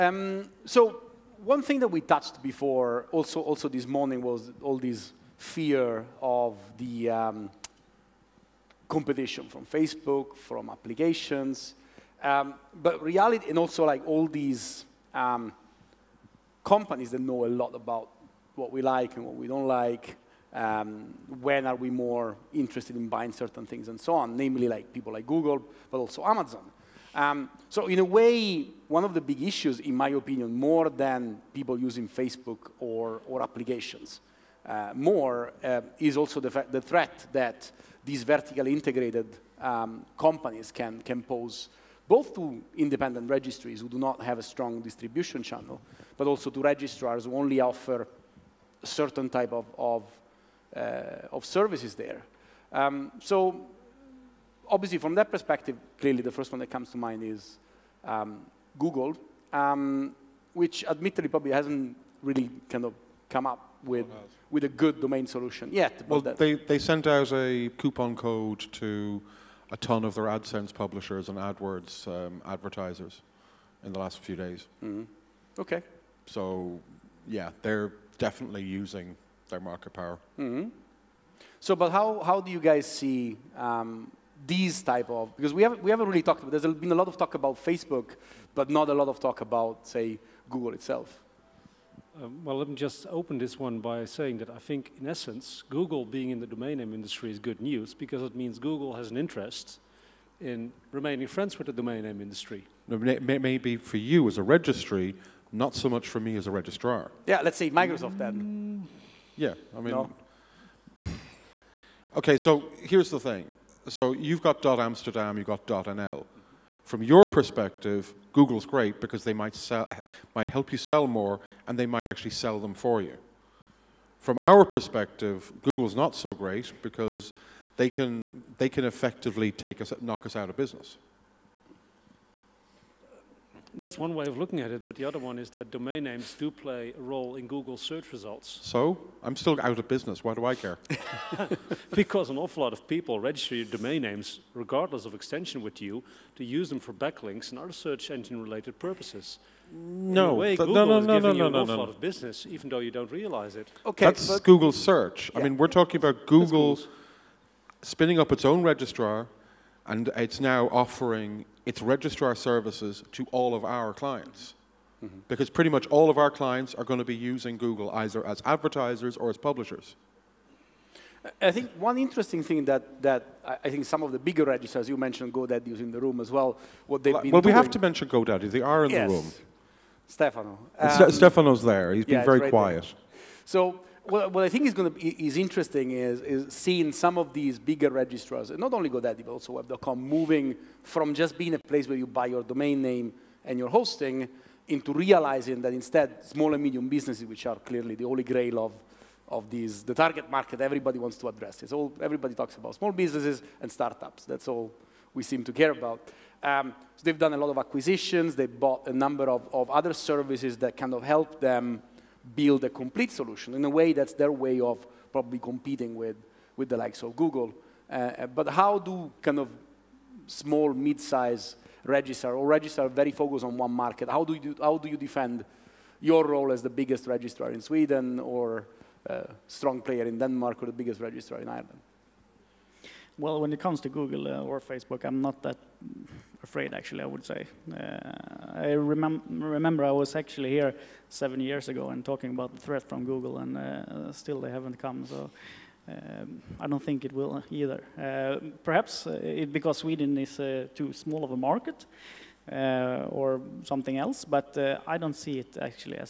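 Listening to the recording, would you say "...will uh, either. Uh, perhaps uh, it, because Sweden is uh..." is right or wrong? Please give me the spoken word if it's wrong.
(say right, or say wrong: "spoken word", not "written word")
right.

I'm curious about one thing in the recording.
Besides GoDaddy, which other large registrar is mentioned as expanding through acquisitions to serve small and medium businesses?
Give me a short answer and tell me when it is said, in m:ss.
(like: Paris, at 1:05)
Web.com, at 3:09.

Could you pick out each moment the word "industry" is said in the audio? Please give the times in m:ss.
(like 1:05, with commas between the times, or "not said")
1:36, 1:42.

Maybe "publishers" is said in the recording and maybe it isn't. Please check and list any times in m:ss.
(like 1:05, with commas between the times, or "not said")
1:10, 2:49.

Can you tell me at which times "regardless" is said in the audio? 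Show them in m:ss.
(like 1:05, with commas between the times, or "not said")
2:24.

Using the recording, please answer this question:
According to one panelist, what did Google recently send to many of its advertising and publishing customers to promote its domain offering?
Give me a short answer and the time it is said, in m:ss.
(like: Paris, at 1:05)
A coupon code, at 1:07.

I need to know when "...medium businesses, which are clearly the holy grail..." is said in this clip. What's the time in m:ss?
3:16.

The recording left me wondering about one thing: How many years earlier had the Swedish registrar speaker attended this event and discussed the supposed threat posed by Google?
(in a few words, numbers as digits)
7.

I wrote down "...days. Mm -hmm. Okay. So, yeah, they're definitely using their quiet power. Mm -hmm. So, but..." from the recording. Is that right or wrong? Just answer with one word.
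wrong.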